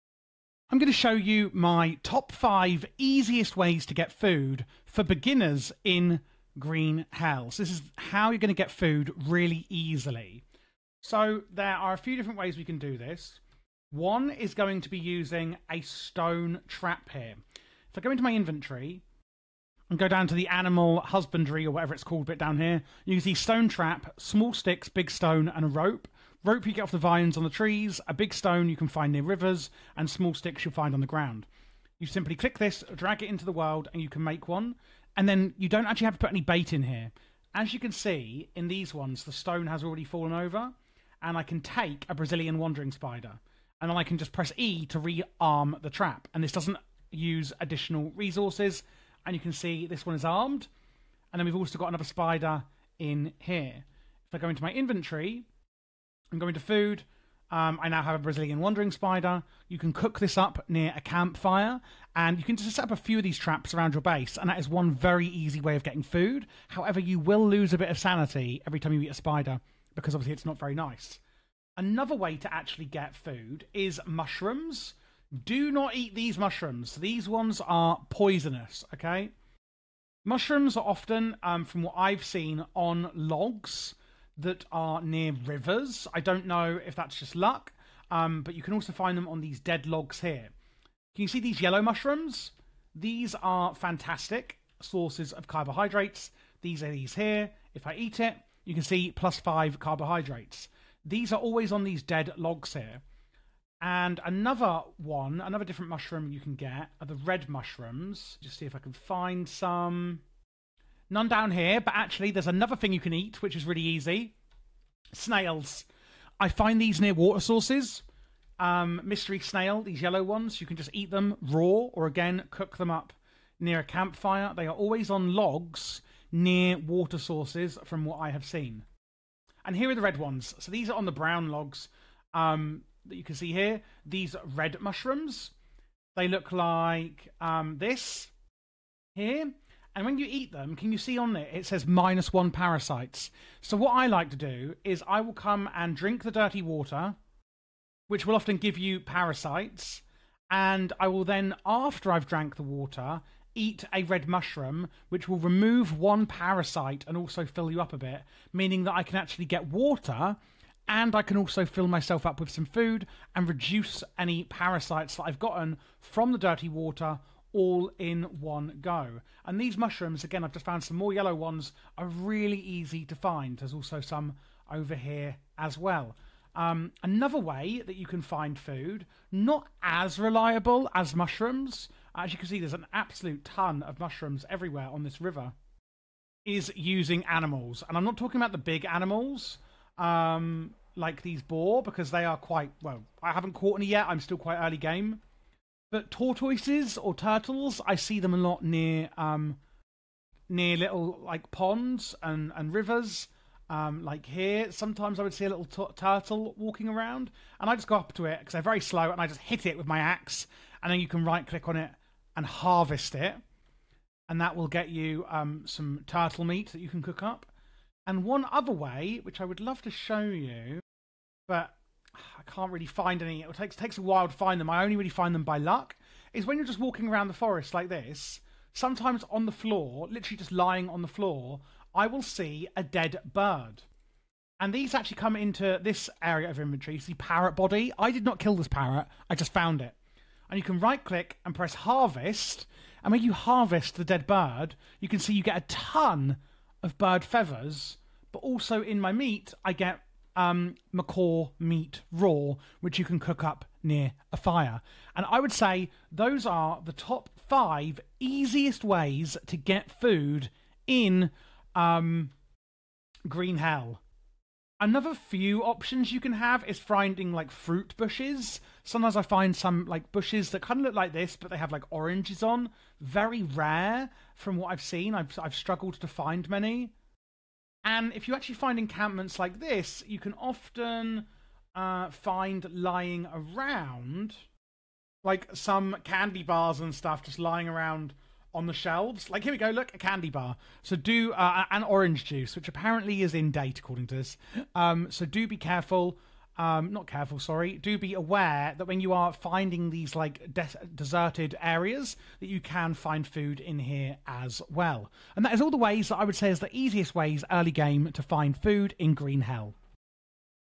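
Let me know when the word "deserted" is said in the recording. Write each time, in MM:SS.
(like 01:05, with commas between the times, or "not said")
05:00.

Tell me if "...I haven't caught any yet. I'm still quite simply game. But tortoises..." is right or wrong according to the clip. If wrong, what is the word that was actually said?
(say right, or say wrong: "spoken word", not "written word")
wrong: "early", not "simply".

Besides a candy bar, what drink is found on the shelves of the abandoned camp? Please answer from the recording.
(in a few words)
orange juice.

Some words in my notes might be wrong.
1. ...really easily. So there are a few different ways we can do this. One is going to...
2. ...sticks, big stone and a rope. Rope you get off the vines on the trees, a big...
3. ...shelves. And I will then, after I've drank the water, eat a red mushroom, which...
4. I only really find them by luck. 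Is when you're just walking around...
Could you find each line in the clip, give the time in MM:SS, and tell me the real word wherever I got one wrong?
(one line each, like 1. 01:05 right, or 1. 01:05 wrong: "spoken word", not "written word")
1. 00:09 right
2. 00:24 right
3. 02:29 wrong: "parasites", not "shelves"
4. 03:44 right.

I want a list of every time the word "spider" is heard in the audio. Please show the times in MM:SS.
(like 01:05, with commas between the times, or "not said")
00:42, 00:52, 00:58, 01:09.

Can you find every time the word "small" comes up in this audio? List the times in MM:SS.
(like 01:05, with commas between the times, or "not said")
00:24, 00:30.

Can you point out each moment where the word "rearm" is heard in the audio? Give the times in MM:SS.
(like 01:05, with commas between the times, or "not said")
00:44.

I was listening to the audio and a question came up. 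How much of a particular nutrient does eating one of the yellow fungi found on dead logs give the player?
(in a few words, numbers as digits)
5 carbohydrates.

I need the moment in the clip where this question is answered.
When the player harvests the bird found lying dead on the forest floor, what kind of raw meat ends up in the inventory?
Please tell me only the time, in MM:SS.
04:10.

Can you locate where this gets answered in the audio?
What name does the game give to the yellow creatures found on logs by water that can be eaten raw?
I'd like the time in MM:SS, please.
01:59.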